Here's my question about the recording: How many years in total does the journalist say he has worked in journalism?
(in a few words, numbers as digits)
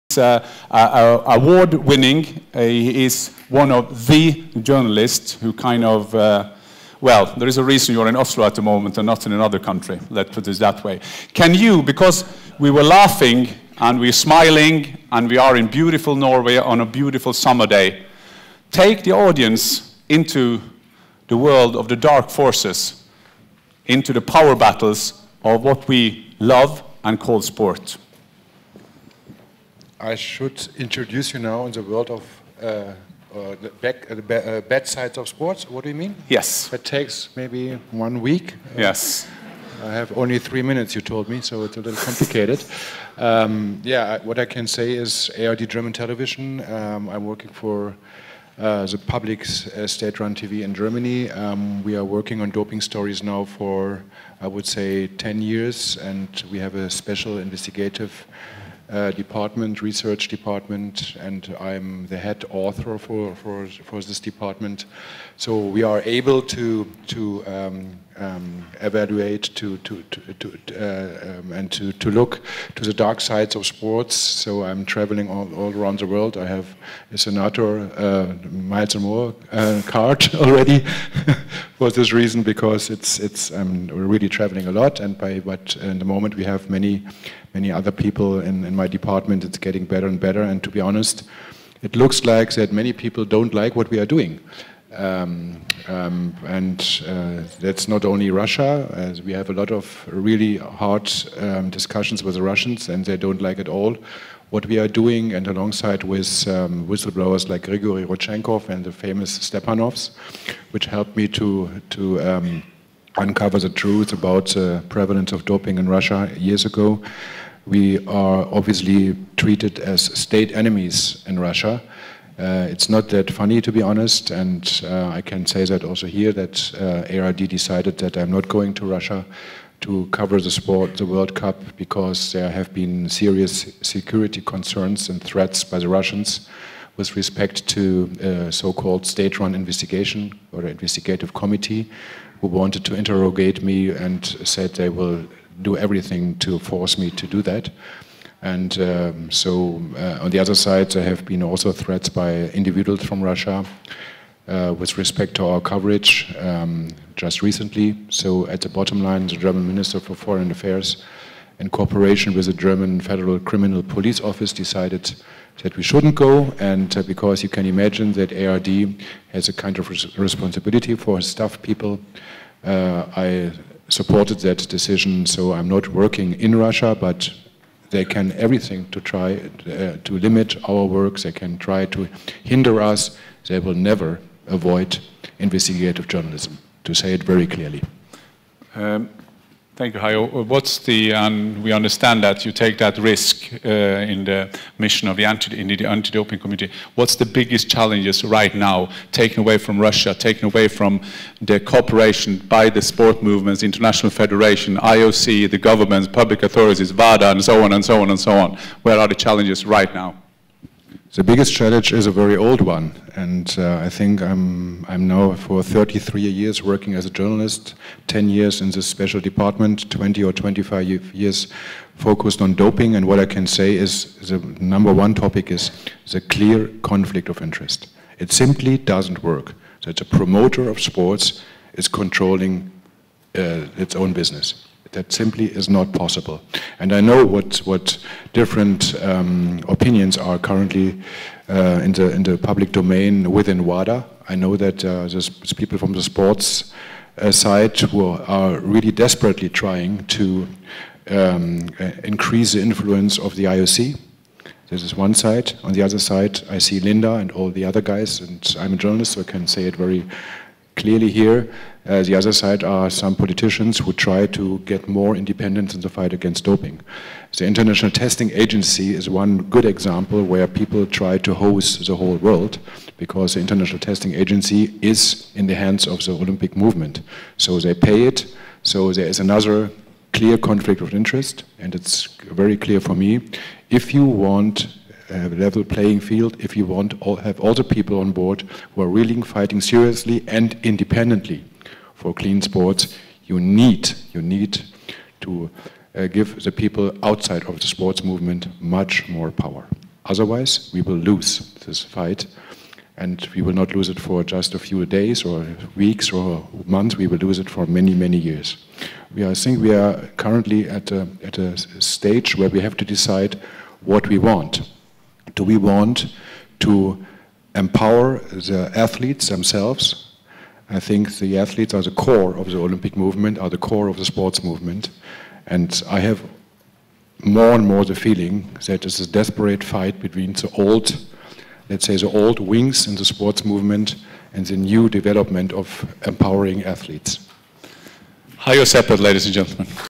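33.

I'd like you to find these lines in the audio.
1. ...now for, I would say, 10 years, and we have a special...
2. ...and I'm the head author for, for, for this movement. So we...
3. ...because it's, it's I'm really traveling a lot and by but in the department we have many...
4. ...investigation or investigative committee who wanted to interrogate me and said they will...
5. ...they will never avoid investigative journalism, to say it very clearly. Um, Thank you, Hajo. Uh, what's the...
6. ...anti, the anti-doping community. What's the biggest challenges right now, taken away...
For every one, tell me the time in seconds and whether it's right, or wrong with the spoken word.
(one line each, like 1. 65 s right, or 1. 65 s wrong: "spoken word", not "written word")
1. 53 s right
2. 61 s wrong: "department", not "movement"
3. 82 s wrong: "moment", not "department"
4. 139 s right
5. 183 s right
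6. 195 s right.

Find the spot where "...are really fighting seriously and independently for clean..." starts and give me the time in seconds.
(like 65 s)
288 s.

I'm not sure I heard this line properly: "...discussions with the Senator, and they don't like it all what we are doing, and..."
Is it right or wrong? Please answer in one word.
wrong.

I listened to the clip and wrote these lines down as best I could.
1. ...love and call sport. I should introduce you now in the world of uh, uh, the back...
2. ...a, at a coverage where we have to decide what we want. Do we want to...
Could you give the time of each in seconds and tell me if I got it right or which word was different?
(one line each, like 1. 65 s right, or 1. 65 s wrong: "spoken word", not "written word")
1. 26 s right
2. 310 s wrong: "stage", not "coverage".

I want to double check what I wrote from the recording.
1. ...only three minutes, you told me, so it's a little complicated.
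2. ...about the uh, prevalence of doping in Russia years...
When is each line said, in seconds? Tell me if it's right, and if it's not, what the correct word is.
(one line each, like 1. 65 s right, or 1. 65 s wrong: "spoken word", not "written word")
1. 40 s right
2. 114 s right.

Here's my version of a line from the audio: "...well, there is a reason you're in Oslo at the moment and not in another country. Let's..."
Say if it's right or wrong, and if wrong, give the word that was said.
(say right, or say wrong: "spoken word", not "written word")
right.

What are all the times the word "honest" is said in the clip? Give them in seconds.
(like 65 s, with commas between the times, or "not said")
90 s, 123 s.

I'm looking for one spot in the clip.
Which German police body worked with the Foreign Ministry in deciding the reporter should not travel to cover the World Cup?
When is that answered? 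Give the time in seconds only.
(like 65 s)
163 s.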